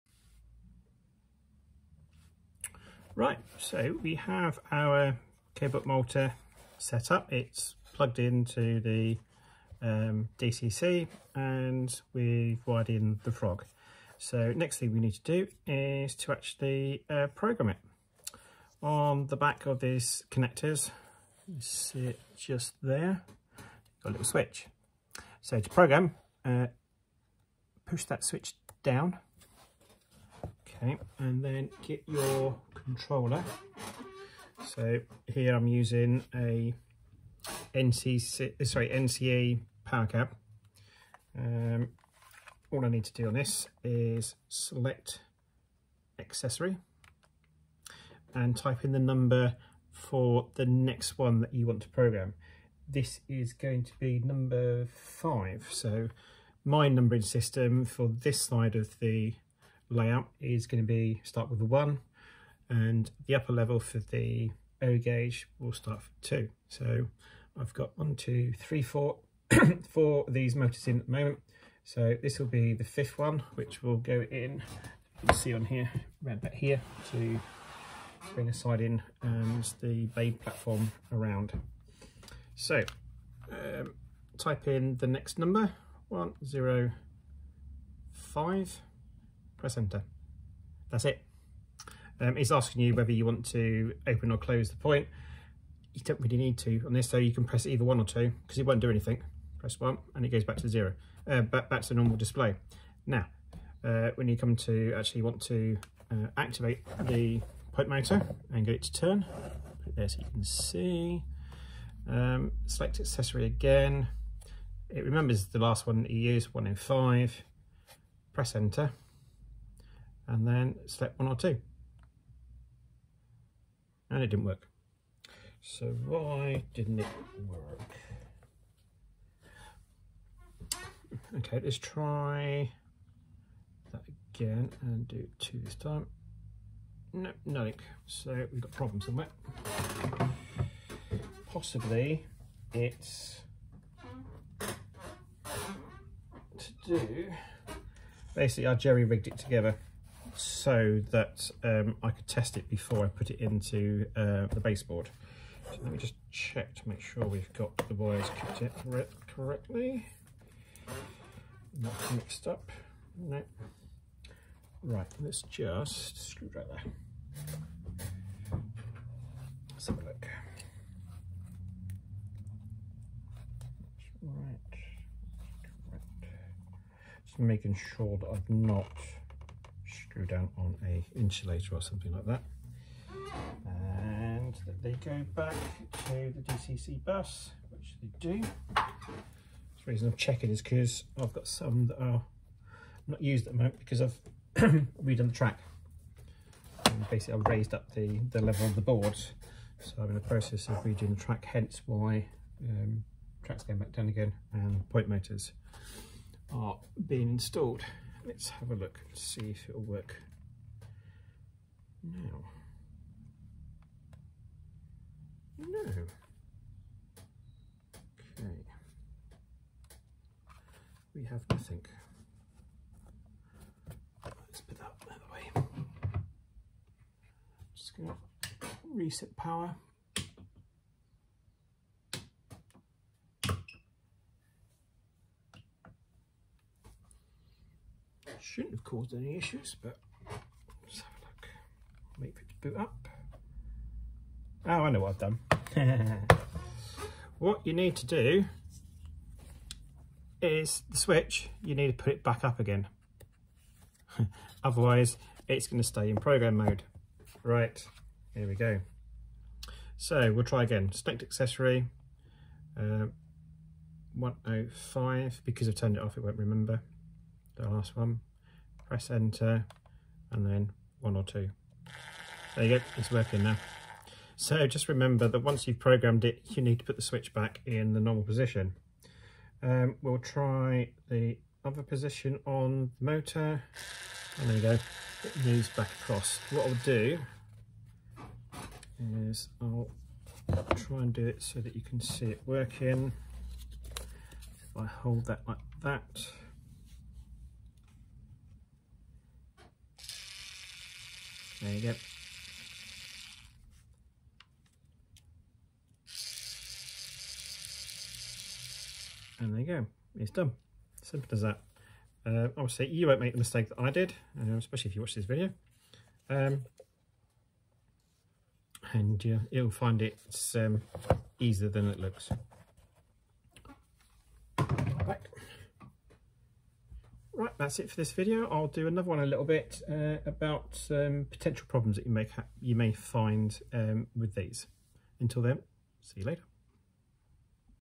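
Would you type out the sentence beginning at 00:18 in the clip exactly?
On the back of these connectors, you see it just there, got a little switch.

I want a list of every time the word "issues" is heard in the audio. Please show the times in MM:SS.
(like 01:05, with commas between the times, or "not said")
03:59.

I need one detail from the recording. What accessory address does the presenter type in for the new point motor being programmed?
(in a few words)
105.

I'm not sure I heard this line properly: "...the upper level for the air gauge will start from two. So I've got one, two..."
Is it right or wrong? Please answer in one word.
right.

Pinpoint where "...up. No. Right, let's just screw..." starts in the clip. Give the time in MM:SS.
02:42.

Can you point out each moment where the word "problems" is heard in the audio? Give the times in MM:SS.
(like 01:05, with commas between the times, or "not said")
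02:18, 05:31.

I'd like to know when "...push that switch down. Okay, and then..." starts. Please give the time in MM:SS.
00:27.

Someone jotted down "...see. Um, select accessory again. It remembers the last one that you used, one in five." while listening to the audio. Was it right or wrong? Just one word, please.
right.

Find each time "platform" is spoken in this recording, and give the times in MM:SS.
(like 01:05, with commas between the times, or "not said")
01:20.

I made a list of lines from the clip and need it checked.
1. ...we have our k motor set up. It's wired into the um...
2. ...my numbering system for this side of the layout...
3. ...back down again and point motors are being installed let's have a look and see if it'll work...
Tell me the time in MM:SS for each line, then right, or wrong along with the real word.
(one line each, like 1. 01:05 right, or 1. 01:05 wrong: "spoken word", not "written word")
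1. 00:04 wrong: "plugged", not "wired"
2. 00:56 right
3. 03:23 right.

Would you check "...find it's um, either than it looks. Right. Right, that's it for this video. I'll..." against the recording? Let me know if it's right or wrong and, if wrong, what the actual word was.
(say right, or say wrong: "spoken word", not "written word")
wrong: "easier", not "either".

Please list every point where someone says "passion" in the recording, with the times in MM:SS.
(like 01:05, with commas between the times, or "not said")
not said.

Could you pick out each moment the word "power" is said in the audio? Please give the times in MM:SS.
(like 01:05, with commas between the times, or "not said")
00:39, 03:49.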